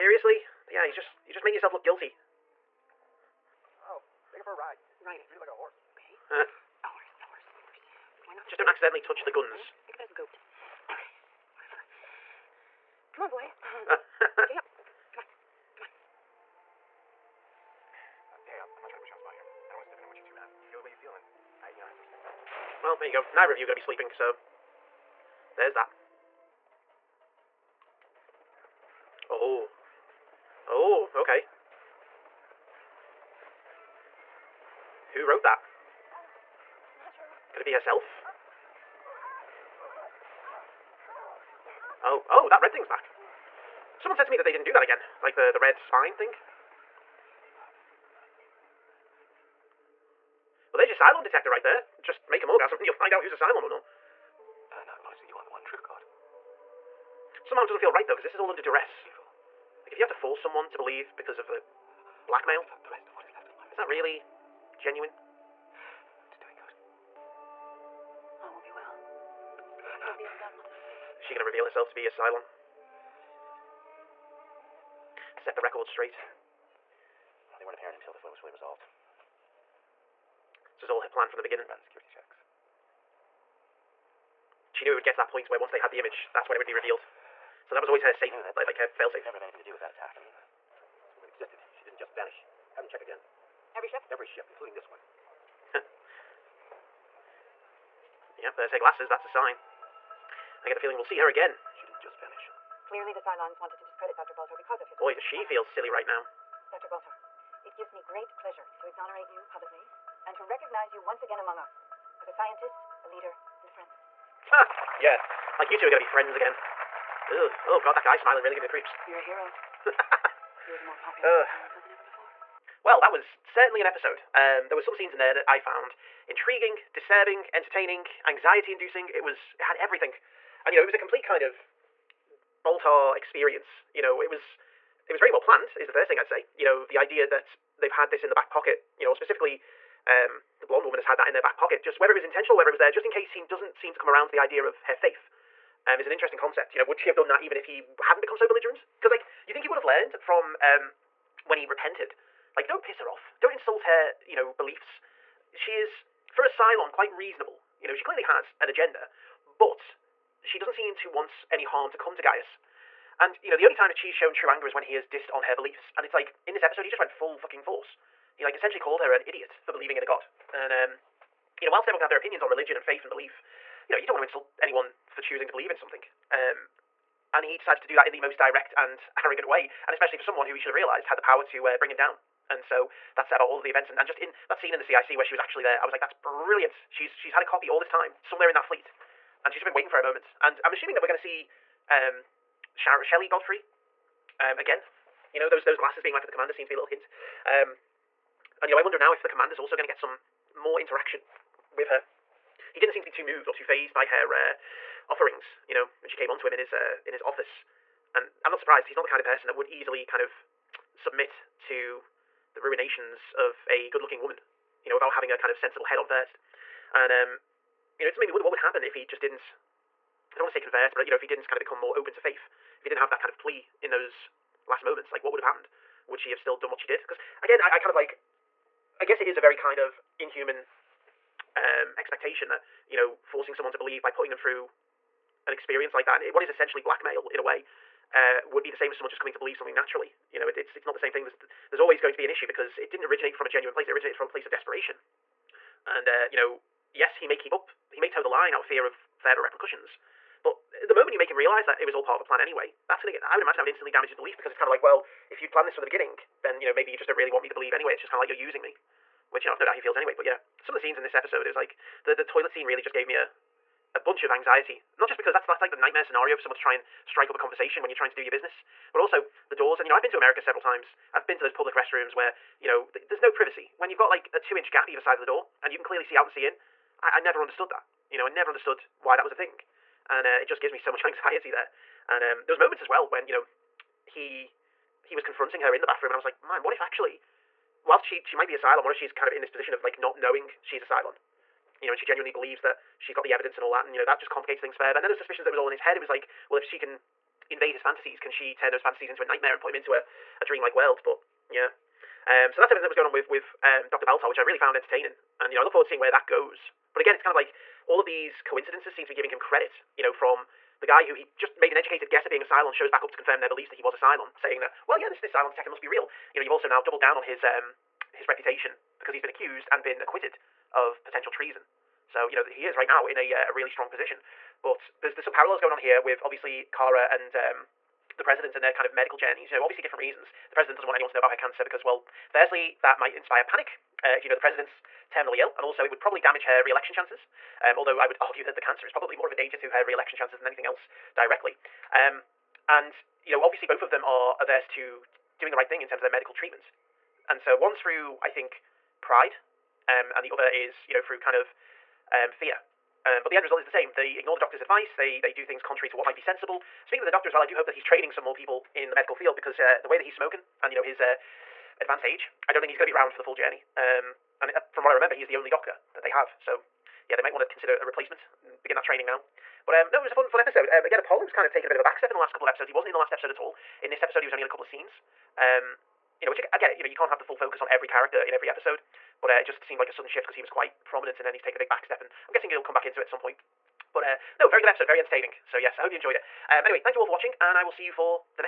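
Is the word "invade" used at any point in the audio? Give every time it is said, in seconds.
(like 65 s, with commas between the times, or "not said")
297 s.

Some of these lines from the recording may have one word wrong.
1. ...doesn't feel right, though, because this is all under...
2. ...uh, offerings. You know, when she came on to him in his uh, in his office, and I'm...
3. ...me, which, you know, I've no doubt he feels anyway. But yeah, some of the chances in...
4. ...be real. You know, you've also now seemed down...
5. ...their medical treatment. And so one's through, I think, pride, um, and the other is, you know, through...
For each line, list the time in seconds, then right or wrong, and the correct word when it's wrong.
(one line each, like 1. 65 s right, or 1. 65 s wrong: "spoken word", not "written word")
1. 57 s right
2. 204 s right
3. 258 s wrong: "scenes", not "chances"
4. 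315 s wrong: "doubled", not "seemed"
5. 346 s right.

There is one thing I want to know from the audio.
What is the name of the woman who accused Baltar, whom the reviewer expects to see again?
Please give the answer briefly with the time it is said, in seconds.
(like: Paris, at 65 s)
Shelley Godfrey, at 193 s.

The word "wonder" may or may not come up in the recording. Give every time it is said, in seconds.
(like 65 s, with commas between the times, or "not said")
198 s, 218 s.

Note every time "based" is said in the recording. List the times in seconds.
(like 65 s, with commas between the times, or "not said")
not said.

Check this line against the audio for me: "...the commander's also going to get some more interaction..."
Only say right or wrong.
right.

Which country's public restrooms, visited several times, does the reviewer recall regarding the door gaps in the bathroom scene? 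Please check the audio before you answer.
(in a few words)
America.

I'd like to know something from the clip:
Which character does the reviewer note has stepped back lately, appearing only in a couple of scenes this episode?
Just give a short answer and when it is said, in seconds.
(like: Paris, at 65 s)
Apollo, at 370 s.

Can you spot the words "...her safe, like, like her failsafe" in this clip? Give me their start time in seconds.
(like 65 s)
88 s.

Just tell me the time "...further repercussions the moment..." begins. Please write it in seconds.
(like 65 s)
249 s.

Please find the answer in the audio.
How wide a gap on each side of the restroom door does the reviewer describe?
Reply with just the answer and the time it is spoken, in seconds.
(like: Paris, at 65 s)
2 inches, at 274 s.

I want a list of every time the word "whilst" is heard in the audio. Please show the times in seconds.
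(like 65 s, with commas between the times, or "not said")
171 s, 287 s.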